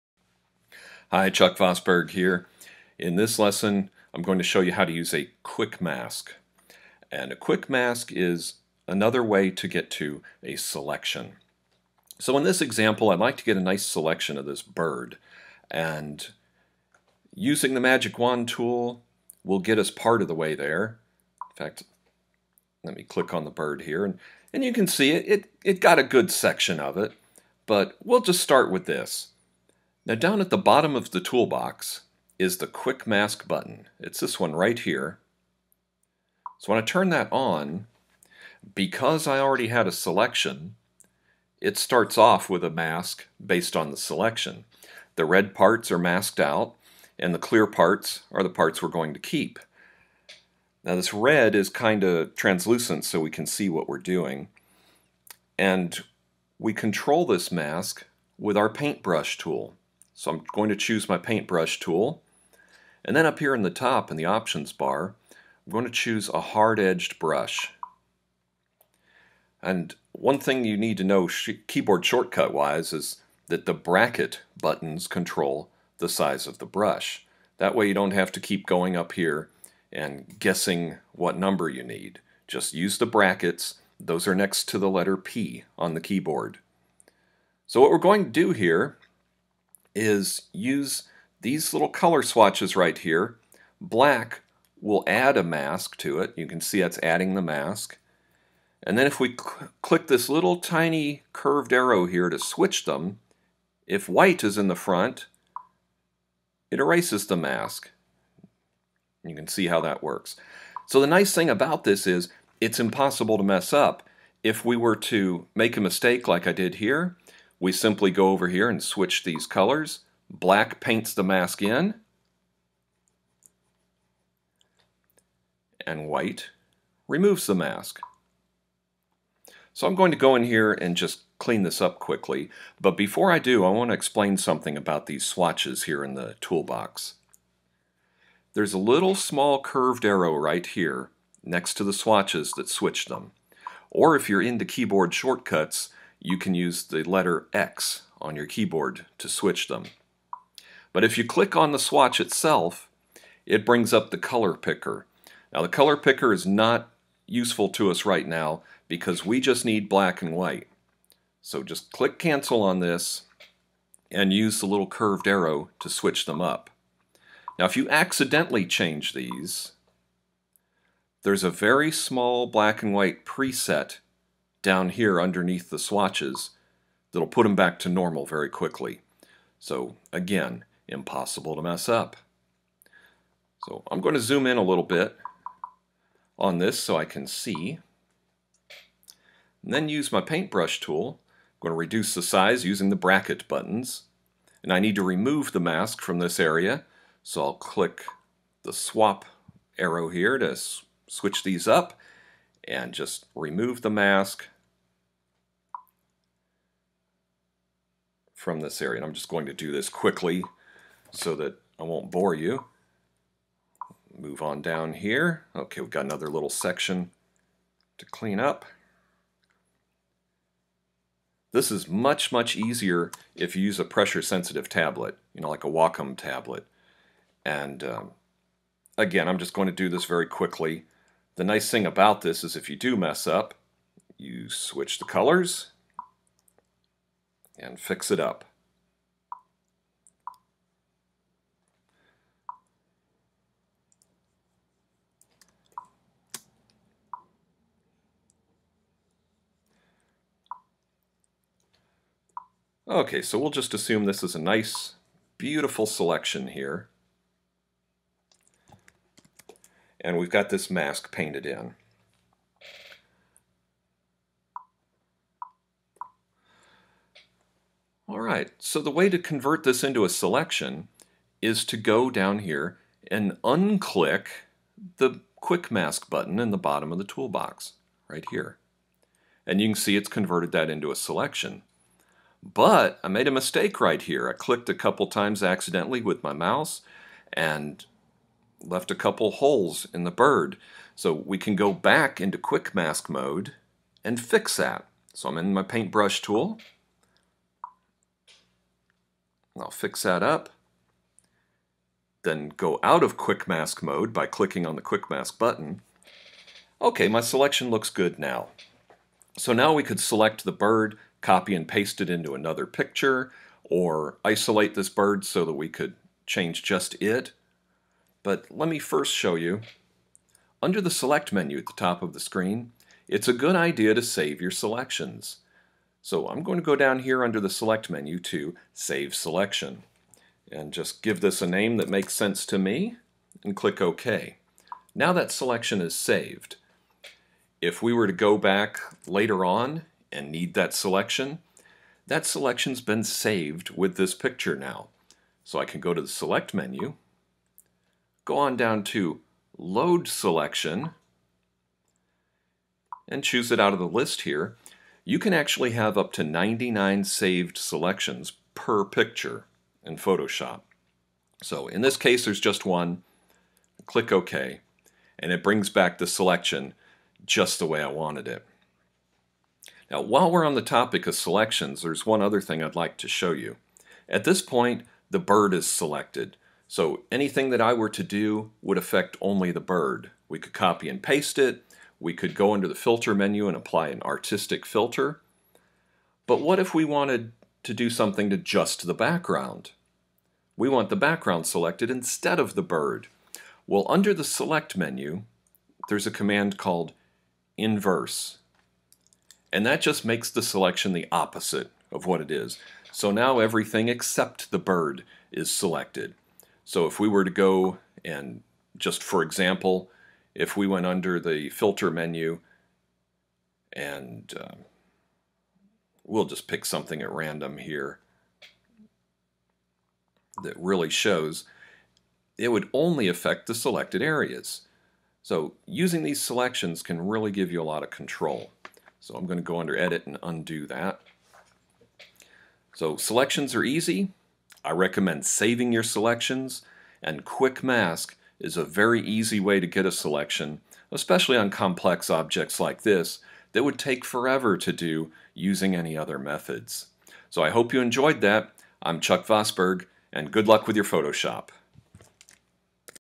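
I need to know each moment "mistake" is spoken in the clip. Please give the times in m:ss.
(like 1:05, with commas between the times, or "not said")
1:55, 4:43.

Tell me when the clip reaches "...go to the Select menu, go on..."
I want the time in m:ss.
5:45.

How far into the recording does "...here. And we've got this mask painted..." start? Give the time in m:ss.
4:16.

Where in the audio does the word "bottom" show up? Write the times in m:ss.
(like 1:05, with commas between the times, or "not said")
0:30, 4:36.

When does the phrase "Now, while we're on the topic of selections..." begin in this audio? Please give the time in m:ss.
6:09.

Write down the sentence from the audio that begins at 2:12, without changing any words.
But before I do, I want to explain something about these swatches here in the toolbox.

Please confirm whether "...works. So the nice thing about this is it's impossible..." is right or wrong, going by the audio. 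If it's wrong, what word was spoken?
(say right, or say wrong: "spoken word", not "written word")
right.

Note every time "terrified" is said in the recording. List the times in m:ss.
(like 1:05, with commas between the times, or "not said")
not said.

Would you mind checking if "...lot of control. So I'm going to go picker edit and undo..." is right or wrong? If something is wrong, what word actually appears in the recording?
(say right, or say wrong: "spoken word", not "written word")
wrong: "under", not "picker".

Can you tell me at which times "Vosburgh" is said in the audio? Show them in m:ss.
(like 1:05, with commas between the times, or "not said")
0:01, 7:29.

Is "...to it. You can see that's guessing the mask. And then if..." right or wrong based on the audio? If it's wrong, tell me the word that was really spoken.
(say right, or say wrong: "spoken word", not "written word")
wrong: "adding", not "guessing".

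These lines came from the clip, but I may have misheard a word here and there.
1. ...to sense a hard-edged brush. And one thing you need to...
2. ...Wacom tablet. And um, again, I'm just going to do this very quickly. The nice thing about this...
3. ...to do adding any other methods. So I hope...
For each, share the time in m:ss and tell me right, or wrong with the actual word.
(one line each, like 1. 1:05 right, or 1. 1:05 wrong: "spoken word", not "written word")
1. 1:05 wrong: "choose", not "sense"
2. 3:45 right
3. 7:24 wrong: "using", not "adding".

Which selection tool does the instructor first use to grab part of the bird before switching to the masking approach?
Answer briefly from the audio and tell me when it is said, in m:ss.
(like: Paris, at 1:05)
magic wand tool, at 0:17.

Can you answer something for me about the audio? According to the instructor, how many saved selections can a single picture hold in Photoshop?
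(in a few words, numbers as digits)
99.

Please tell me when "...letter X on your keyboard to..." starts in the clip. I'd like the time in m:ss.
2:27.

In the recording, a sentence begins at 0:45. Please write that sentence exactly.
The red parts are masked out, and the clear parts are the parts we're going to keep.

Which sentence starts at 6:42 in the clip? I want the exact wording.
So now everything except the bird is selected.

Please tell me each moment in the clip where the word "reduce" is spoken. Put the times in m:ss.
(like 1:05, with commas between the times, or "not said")
3:11.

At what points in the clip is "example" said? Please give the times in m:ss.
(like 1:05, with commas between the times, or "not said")
0:12, 6:49.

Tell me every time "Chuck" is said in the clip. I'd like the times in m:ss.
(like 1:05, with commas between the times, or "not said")
0:01, 7:28.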